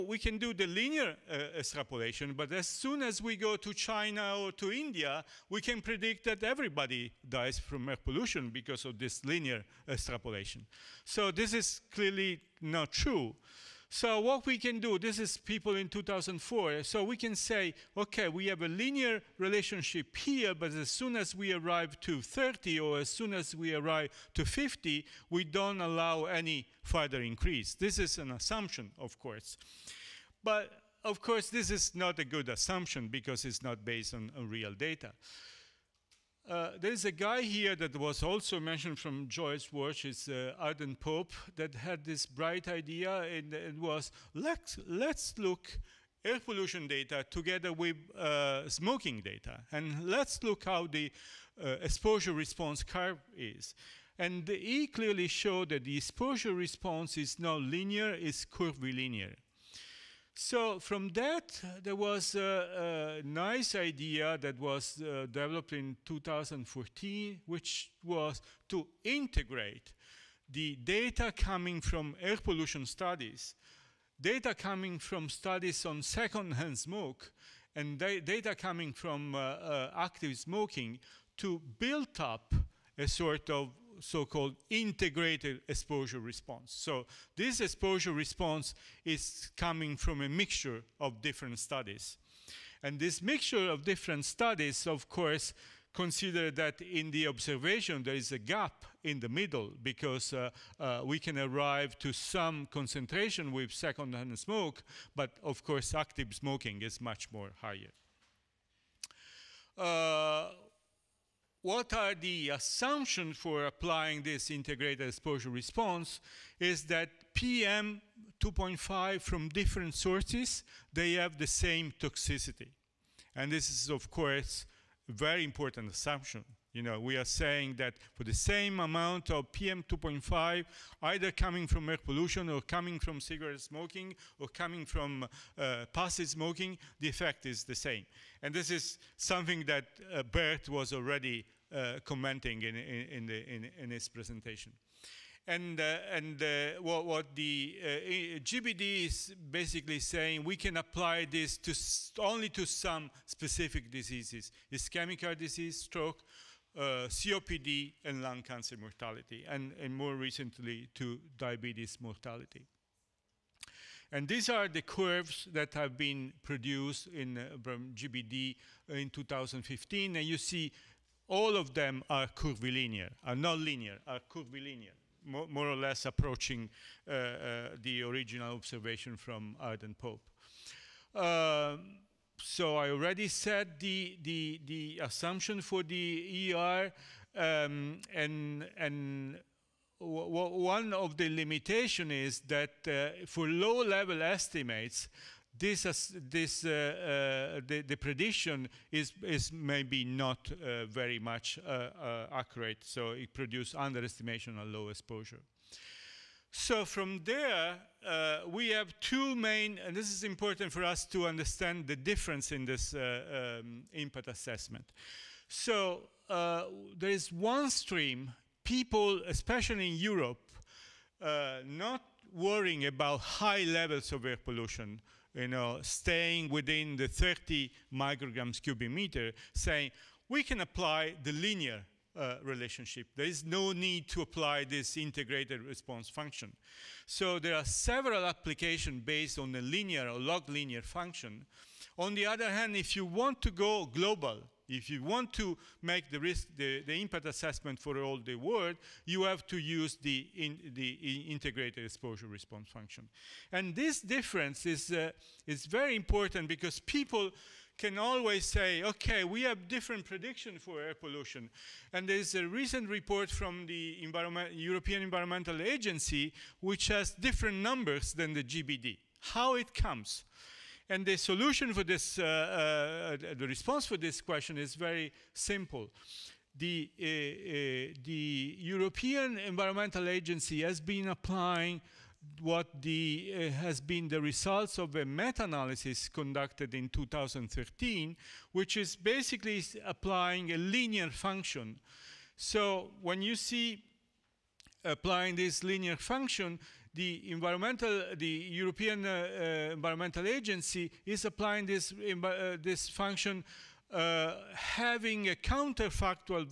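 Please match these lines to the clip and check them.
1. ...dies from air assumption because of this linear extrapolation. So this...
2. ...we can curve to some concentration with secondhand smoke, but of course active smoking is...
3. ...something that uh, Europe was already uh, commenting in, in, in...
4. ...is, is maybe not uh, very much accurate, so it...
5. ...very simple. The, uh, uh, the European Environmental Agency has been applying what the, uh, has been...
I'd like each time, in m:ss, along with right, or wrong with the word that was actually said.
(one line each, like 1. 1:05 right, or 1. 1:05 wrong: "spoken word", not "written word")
1. 0:07 wrong: "pollution", not "assumption"
2. 1:41 wrong: "arrive", not "curve"
3. 2:19 wrong: "Bert", not "Europe"
4. 3:18 right
5. 4:34 right.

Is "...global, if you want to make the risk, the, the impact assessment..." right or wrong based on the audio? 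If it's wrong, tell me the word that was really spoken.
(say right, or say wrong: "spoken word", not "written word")
right.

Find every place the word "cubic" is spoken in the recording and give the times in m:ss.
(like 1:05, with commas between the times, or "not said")
3:48.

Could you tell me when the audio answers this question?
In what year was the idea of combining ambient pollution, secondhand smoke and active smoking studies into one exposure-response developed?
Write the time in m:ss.
1:06.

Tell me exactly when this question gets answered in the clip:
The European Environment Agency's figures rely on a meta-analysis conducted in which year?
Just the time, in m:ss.
4:46.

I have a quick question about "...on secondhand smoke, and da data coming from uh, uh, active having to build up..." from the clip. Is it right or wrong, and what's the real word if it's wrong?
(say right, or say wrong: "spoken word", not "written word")
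wrong: "smoking", not "having".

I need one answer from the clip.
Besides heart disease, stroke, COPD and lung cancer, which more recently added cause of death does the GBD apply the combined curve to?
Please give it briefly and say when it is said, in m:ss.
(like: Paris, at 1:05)
Diabetes mortality, at 2:41.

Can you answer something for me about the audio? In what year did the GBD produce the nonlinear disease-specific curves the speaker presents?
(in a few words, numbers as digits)
2015.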